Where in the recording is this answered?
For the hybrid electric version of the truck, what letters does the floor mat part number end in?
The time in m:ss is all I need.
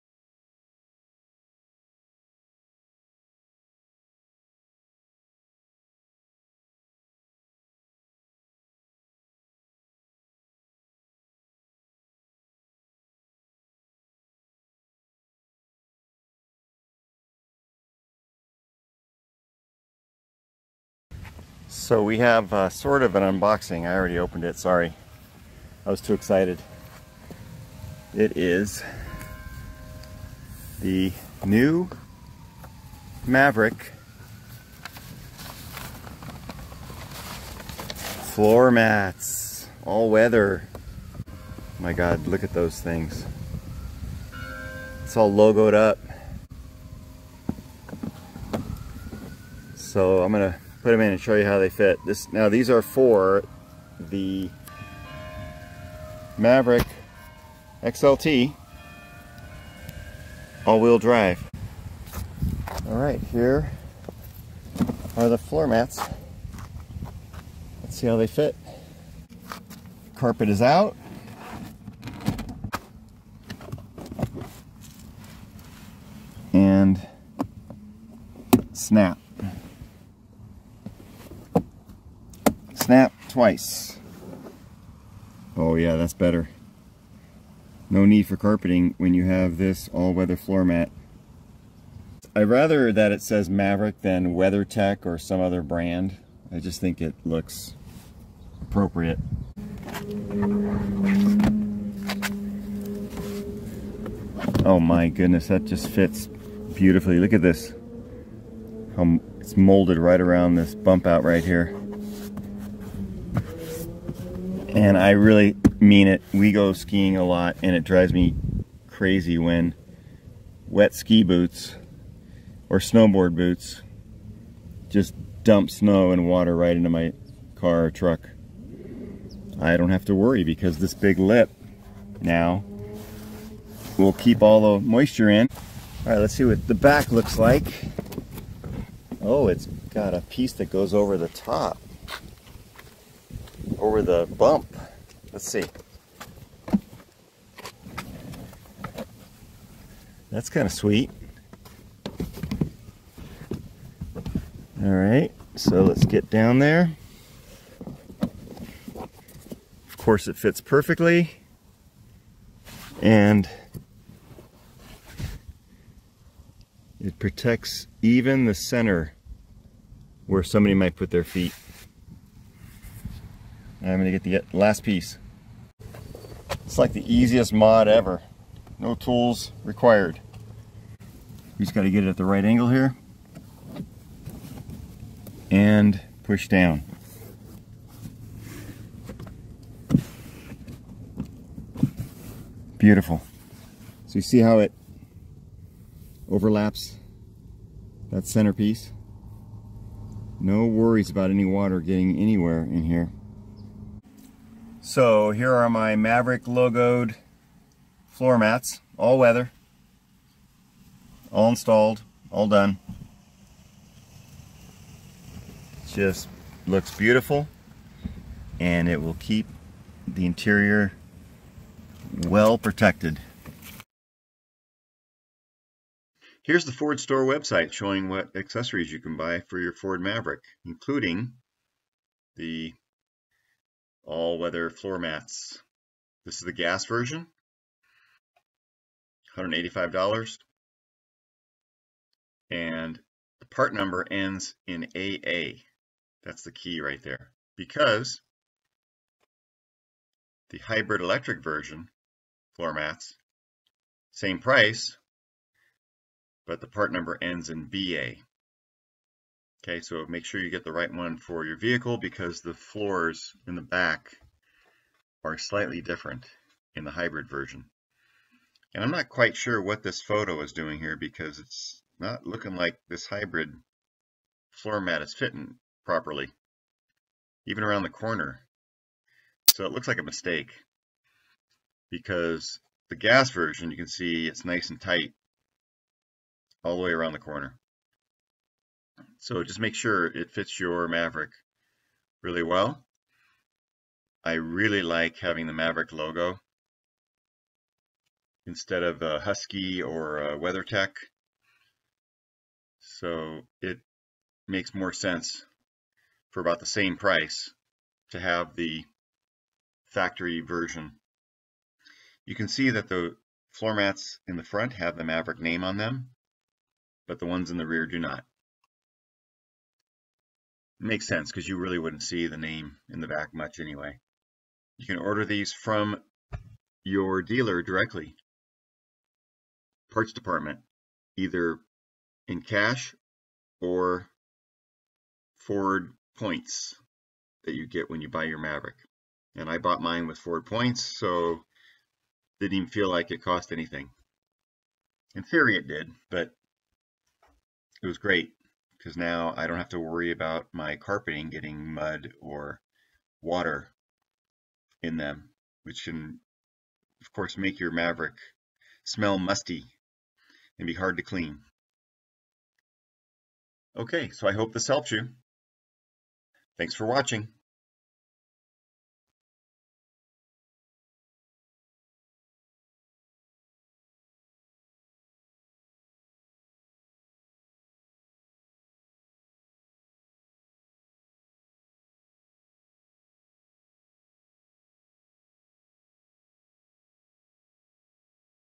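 4:17.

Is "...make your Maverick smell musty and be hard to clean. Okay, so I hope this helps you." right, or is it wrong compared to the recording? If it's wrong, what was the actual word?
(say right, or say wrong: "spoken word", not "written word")
right.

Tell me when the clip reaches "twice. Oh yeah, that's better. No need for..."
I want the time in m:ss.
1:23.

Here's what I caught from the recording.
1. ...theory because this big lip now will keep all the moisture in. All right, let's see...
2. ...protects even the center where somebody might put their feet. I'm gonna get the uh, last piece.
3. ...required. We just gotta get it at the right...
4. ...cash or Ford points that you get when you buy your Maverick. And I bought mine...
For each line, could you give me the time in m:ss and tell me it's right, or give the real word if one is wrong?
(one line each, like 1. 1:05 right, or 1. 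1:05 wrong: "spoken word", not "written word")
1. 2:10 wrong: "worry", not "theory"
2. 2:47 right
3. 2:59 right
4. 5:32 right.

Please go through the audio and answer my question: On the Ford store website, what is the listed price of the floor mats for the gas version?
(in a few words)
$185.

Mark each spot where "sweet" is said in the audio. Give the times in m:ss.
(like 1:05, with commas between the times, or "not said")
2:30.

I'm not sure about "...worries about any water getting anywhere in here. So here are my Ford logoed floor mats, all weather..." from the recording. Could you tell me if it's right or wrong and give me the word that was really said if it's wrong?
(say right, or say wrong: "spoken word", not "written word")
wrong: "Maverick", not "Ford".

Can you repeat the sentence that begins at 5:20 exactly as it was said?
Makes sense because you really wouldn't see the name in the back much anyway.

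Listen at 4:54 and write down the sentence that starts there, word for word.
I really like having the Maverick logo instead of a Husky or a WeatherTech.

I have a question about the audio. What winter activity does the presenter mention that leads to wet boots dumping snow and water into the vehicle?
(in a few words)
Skiing.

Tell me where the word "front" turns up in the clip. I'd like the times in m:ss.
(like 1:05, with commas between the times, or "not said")
5:14.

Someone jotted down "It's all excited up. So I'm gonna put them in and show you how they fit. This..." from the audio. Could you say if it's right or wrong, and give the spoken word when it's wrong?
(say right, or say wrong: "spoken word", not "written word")
wrong: "logoed", not "excited".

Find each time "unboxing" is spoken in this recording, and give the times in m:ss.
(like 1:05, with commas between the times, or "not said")
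0:23.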